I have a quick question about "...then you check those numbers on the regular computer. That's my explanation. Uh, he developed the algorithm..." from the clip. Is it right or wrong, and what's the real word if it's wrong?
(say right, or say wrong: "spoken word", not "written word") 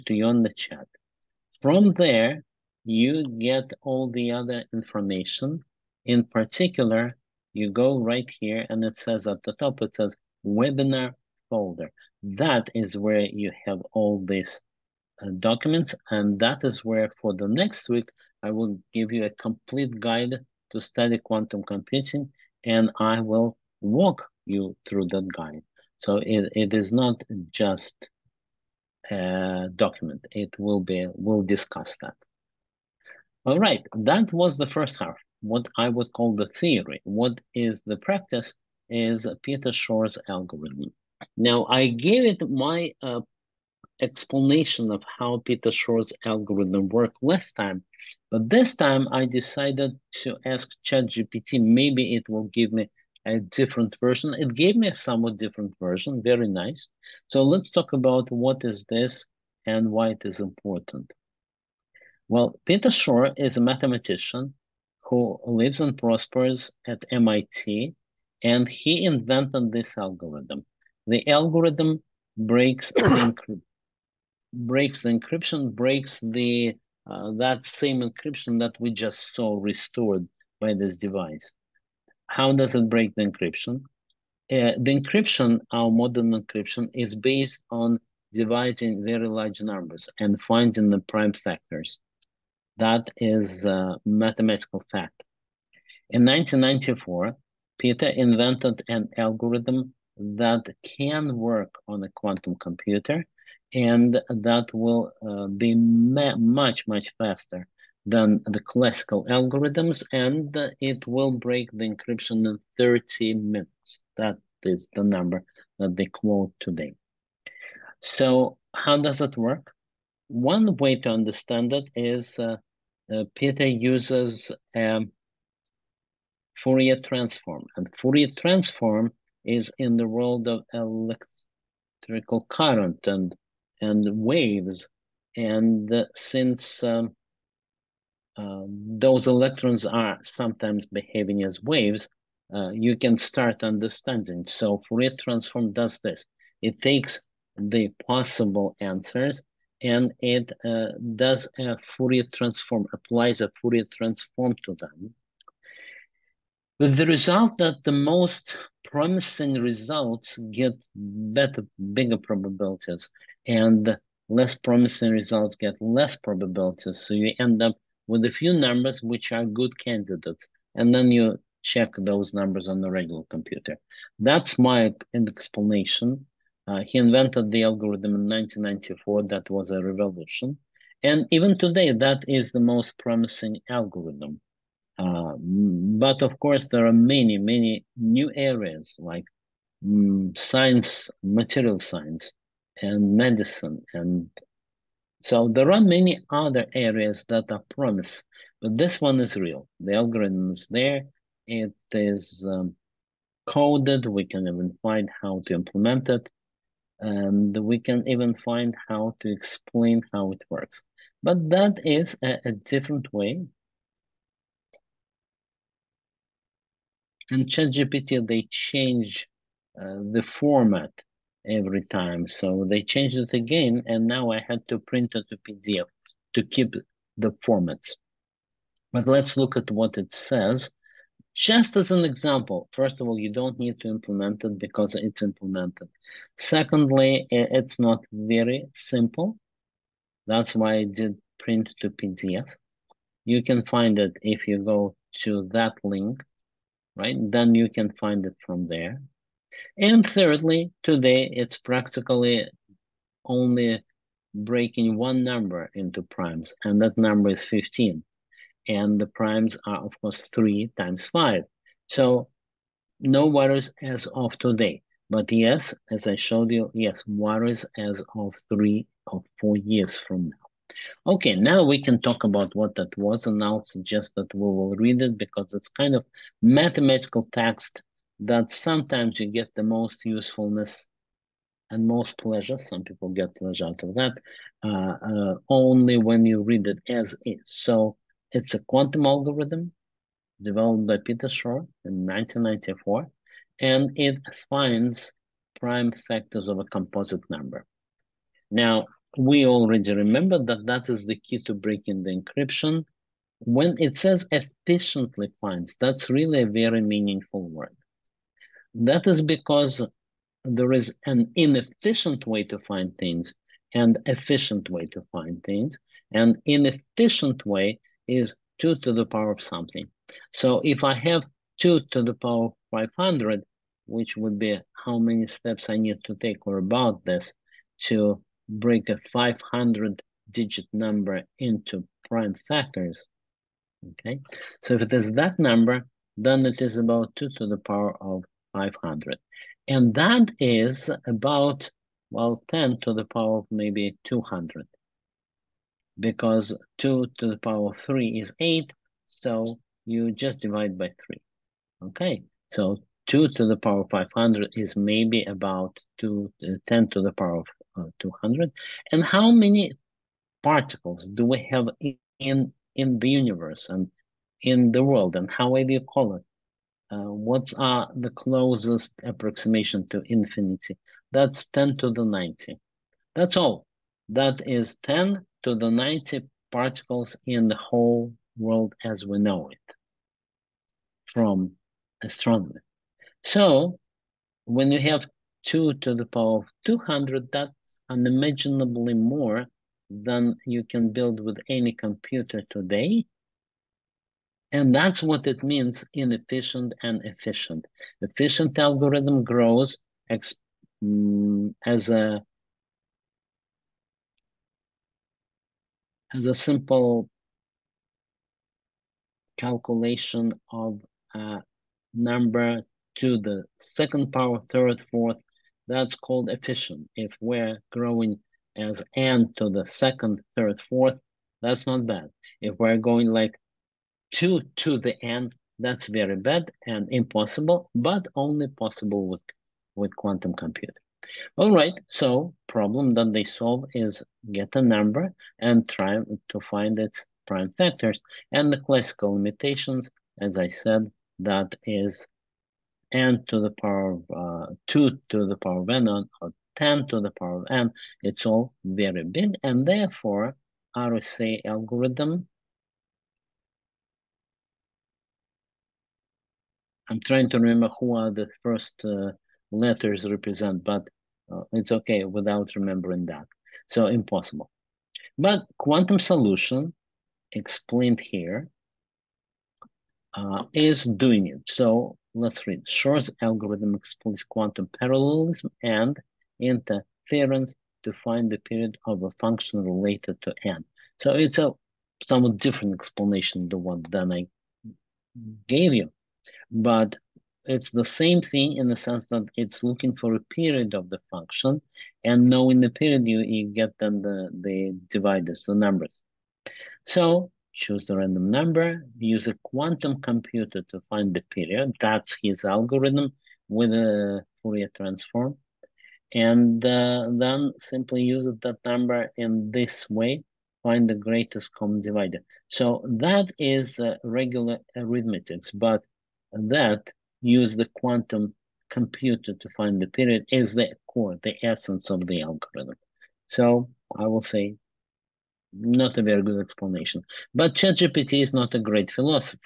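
wrong: "invented", not "developed".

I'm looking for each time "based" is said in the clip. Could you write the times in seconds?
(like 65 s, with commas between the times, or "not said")
87 s.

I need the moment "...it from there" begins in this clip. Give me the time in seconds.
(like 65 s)
248 s.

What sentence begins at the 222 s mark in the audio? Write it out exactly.
So they changed it again, and now I had to print it to PDF to keep the formats.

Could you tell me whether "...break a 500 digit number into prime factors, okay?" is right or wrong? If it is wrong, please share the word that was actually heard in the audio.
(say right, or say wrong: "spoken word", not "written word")
right.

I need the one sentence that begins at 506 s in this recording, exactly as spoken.
And uh, then simply use that number in this way, find the greatest common divisor.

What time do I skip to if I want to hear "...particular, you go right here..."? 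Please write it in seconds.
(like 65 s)
6 s.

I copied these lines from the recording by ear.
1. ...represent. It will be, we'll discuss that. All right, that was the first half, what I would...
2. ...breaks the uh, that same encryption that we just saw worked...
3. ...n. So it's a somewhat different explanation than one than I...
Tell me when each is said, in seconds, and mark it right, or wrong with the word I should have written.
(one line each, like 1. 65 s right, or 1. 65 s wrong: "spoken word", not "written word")
1. 29 s wrong: "document", not "represent"
2. 75 s wrong: "restored", not "worked"
3. 480 s right.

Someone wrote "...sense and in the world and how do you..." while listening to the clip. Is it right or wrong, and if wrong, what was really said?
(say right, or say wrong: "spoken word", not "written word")
wrong: "universe", not "sense".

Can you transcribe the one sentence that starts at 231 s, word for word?
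Just as an example, first of all, you don't need to implement it because it's implemented.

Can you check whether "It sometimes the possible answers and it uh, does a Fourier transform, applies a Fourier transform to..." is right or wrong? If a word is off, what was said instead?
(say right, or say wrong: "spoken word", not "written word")
wrong: "takes", not "sometimes".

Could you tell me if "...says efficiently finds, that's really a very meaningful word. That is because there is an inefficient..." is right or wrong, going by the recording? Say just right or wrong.
right.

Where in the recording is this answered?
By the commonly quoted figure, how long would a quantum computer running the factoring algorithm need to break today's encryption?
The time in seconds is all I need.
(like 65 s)
112 s.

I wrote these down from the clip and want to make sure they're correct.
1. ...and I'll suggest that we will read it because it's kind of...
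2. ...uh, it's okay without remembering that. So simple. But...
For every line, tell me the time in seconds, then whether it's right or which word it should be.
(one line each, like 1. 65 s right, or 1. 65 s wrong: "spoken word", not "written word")
1. 273 s right
2. 461 s wrong: "impossible", not "simple".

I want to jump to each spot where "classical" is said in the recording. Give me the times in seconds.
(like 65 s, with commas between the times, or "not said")
108 s, 438 s.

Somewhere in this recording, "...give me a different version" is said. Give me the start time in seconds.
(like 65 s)
52 s.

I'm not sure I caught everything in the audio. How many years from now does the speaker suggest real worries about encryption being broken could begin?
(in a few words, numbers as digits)
3 or 4 years.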